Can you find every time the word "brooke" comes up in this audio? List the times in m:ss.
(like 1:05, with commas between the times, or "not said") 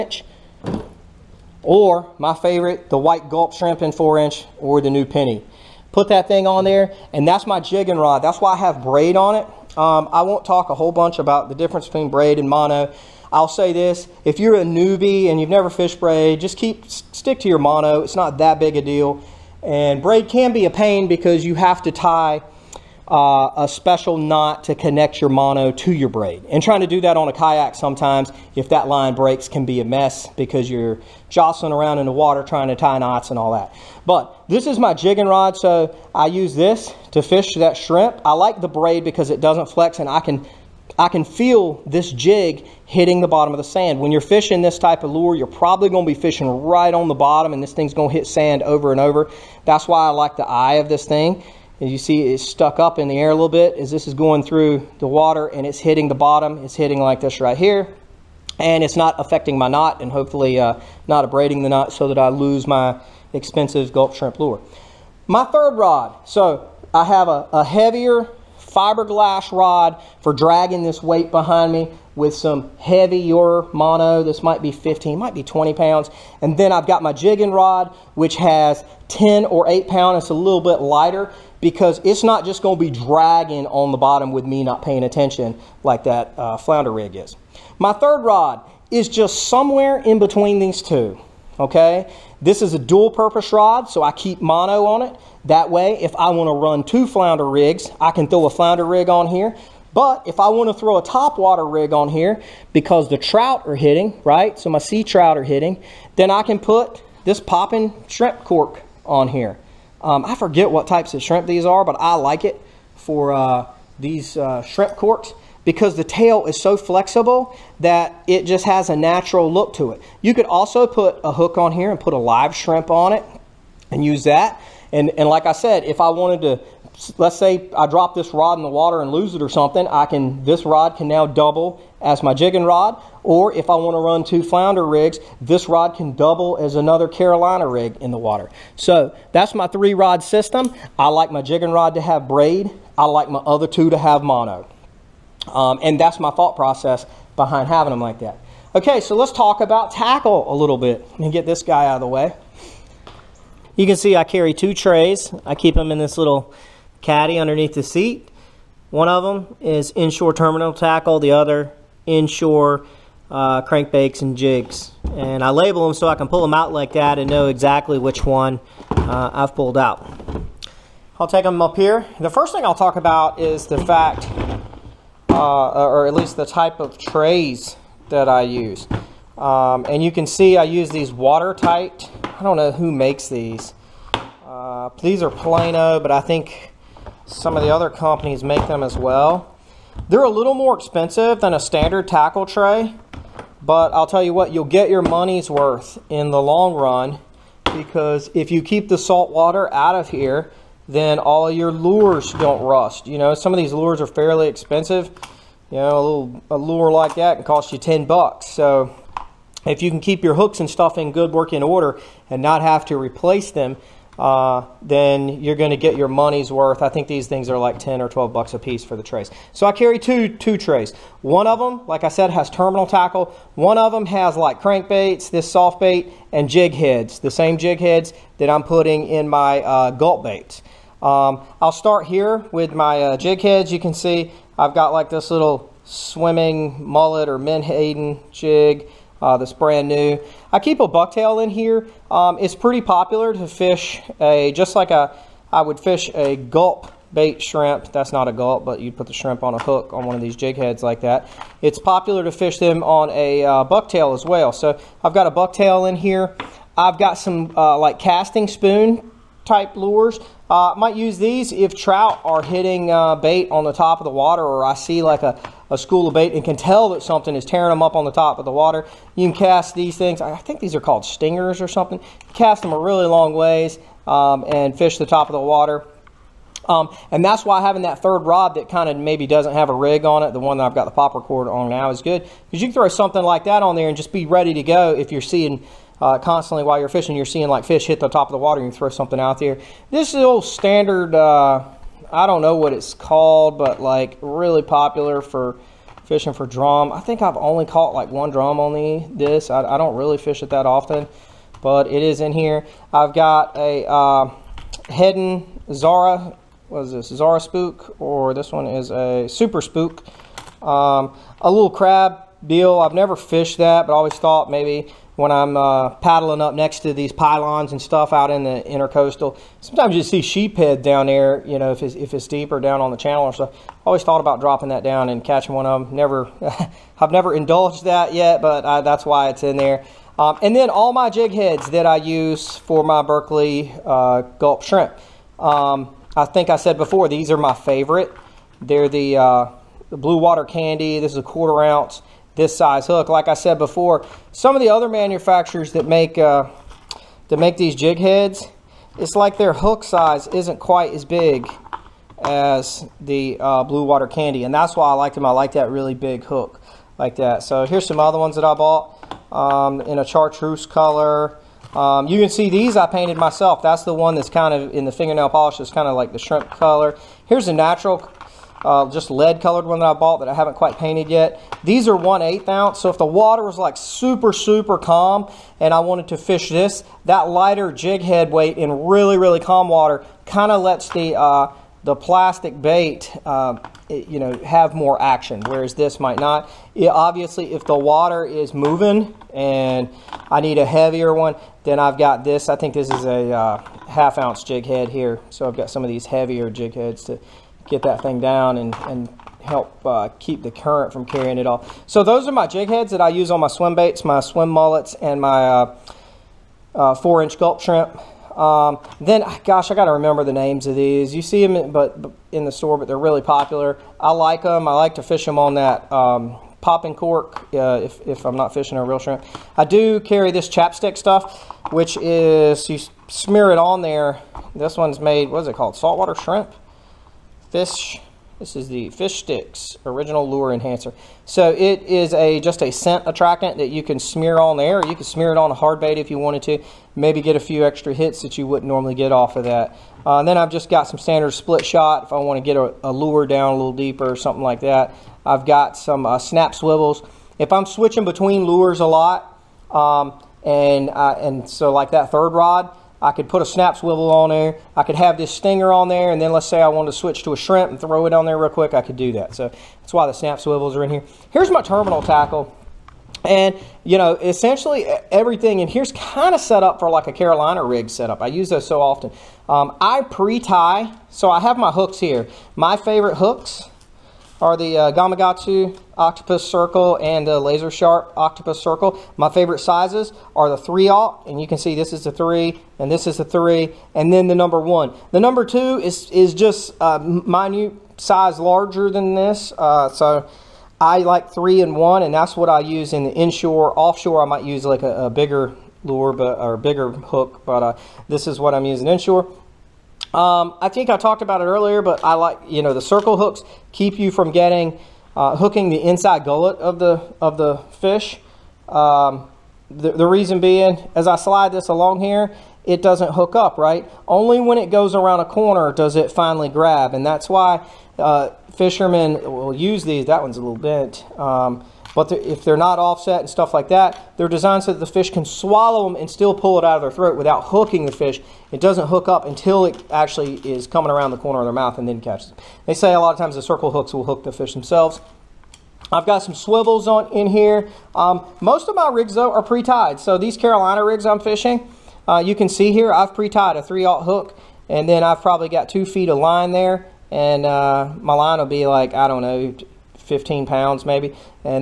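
not said.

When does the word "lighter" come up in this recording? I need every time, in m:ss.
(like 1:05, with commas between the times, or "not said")
1:20, 6:17.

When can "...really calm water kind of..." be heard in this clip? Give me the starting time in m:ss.
6:19.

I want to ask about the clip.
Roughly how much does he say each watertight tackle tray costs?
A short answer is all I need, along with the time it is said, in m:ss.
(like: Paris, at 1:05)
10 or 12 bucks, at 3:37.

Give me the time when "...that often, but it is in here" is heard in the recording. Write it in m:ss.
5:00.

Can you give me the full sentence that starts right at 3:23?
You know, some of these lures are fairly expensive.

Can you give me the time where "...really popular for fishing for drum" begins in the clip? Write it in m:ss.
4:54.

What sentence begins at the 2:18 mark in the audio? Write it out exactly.
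So that's my three rod system.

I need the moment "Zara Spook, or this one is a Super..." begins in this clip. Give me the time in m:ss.
5:07.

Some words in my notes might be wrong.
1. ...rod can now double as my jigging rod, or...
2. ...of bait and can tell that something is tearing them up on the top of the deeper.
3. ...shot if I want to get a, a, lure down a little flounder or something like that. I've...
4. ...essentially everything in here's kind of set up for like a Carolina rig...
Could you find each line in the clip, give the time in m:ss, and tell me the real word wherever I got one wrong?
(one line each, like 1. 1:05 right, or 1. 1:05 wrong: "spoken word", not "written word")
1. 2:10 right
2. 4:26 wrong: "water", not "deeper"
3. 7:21 wrong: "deeper", not "flounder"
4. 7:44 right.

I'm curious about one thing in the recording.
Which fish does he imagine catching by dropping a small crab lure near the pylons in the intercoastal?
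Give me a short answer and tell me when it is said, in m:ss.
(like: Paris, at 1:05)
Sheephead, at 5:20.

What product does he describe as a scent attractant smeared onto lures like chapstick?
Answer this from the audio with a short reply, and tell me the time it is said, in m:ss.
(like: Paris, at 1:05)
Fish Sticks Original Lure Enhancer, at 7:08.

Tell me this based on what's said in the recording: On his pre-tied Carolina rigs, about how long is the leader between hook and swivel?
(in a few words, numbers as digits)
2 feet.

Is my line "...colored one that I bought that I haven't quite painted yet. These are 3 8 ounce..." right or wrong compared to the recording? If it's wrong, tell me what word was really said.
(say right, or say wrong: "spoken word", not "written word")
wrong: "1", not "3".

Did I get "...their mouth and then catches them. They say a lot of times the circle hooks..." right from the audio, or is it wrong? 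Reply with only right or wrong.
right.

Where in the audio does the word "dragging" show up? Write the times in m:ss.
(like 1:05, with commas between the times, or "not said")
1:10, 1:22.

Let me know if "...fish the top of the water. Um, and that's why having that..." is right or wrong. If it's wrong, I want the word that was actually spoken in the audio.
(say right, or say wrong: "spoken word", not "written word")
right.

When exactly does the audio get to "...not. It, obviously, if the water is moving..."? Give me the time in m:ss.
6:26.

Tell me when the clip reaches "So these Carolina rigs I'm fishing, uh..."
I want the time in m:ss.
8:59.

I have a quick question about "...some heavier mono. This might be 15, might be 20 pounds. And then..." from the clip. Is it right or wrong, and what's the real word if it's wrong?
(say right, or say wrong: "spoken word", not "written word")
right.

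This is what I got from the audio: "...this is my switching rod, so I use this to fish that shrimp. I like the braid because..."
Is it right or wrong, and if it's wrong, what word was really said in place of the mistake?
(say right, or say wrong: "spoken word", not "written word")
wrong: "jigging", not "switching".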